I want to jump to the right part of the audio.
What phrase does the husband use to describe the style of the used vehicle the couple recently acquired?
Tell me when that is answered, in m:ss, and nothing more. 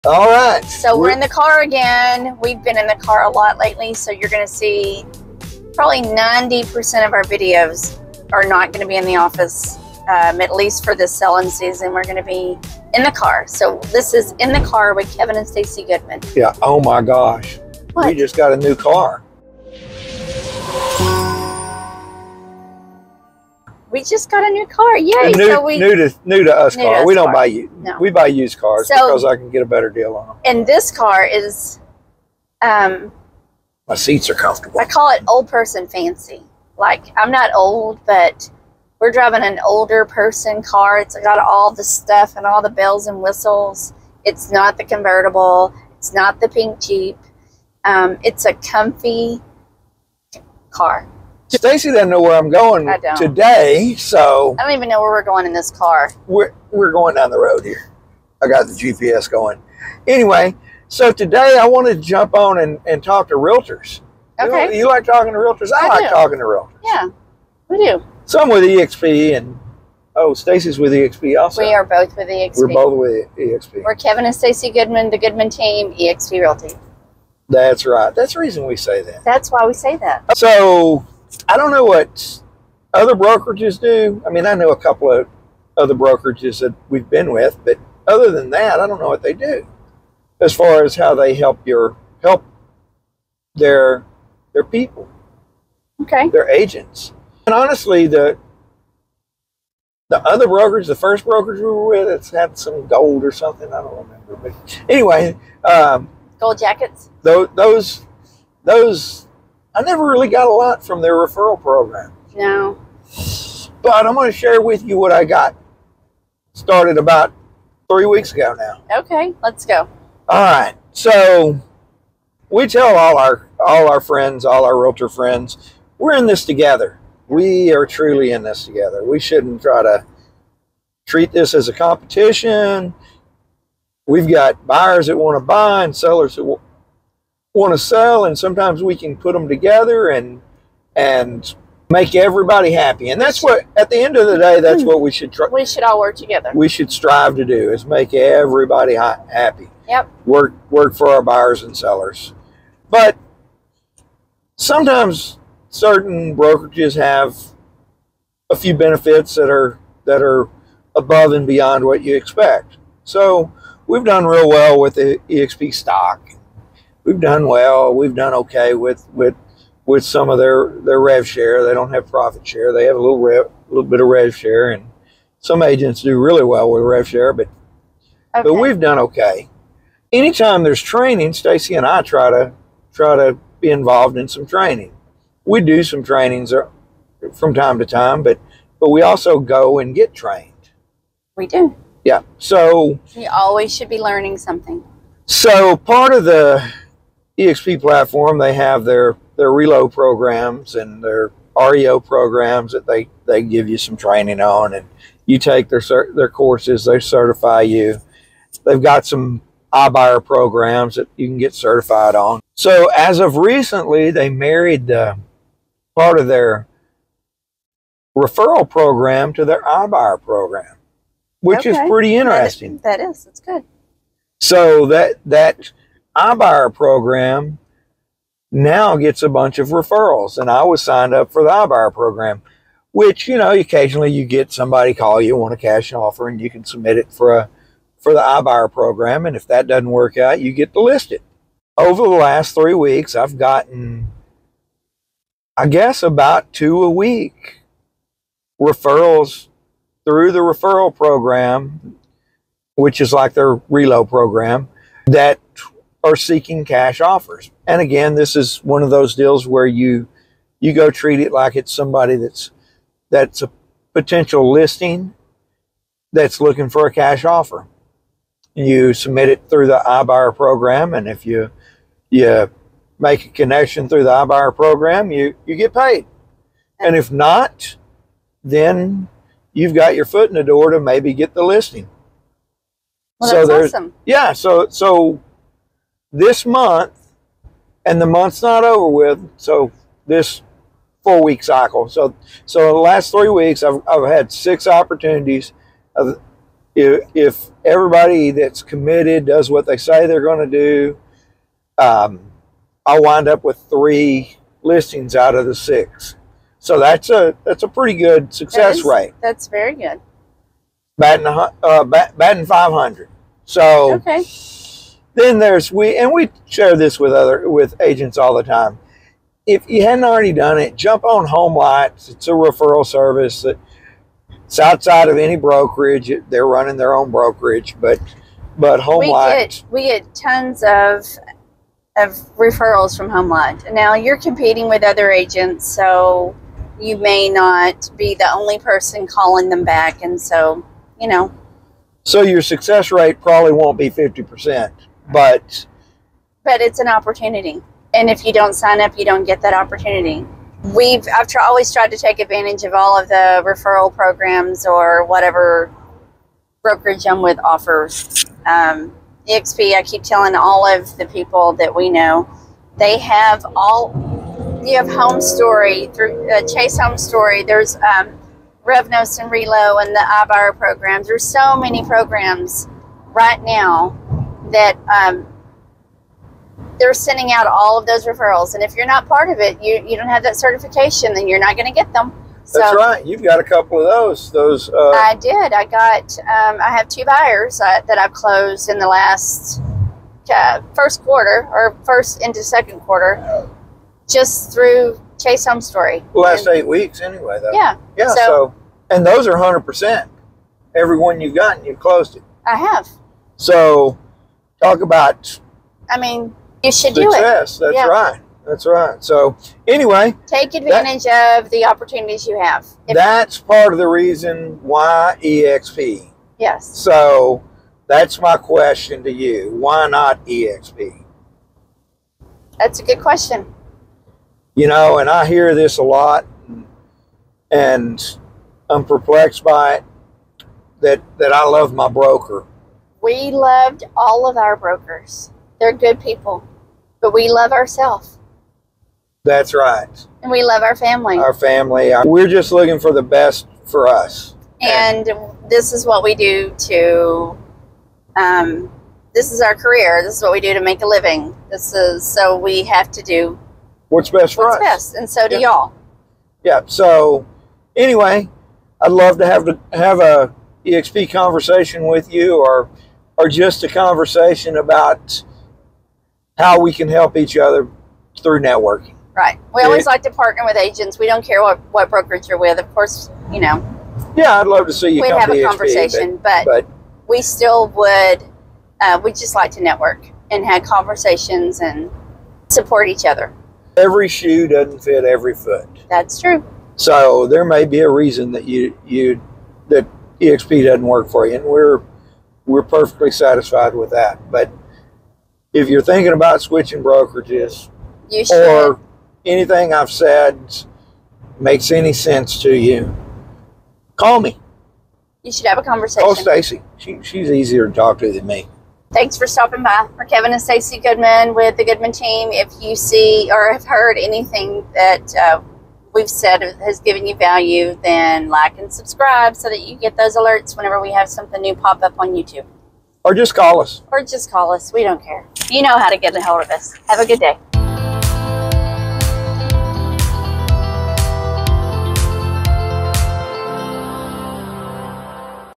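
0:35.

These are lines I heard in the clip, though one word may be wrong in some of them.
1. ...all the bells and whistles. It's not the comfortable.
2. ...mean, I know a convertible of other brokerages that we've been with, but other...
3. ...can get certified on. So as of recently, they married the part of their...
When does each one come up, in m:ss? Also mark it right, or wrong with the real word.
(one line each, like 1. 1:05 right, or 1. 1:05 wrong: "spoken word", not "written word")
1. 0:42 wrong: "convertible", not "comfortable"
2. 1:24 wrong: "couple", not "convertible"
3. 3:31 right.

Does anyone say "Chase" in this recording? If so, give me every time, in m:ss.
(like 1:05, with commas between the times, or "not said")
6:06, 6:35.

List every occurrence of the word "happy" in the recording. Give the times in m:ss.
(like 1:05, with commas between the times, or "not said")
2:22, 2:28.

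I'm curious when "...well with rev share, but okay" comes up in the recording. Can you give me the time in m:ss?
2:56.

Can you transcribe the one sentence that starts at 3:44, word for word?
So that that iBuyer program now gets a bunch of referrals.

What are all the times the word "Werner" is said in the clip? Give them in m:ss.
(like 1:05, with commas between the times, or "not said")
not said.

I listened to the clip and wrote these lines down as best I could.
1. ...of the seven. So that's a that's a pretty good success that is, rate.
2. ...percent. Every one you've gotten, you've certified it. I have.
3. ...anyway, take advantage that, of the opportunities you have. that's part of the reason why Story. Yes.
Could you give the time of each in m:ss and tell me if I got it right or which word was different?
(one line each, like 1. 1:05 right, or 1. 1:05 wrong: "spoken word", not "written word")
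1. 5:05 wrong: "six", not "seven"
2. 6:39 wrong: "closed", not "certified"
3. 6:49 wrong: "EXP", not "Story".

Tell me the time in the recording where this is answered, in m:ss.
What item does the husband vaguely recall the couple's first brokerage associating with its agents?
1:46.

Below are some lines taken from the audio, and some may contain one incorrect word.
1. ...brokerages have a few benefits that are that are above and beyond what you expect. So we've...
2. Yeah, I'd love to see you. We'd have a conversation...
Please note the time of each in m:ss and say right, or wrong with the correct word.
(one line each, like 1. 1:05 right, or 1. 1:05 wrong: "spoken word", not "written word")
1. 2:36 right
2. 7:54 right.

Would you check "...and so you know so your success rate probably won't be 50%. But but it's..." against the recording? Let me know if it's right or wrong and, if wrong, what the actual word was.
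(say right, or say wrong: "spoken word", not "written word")
right.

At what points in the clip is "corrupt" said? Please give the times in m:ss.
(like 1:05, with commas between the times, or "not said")
not said.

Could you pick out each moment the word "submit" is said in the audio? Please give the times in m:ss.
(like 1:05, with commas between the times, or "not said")
3:56, 4:28.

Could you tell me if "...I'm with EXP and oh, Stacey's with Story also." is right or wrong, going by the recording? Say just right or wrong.
wrong.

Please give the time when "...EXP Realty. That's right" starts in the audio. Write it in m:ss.
1:15.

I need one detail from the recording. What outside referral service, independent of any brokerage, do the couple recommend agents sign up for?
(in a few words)
HomeLight.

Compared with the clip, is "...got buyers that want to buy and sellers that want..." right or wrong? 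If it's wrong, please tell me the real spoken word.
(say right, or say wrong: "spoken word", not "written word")
right.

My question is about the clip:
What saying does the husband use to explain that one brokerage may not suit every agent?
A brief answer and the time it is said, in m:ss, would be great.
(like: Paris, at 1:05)
Every shoe doesn't fit every foot, at 8:03.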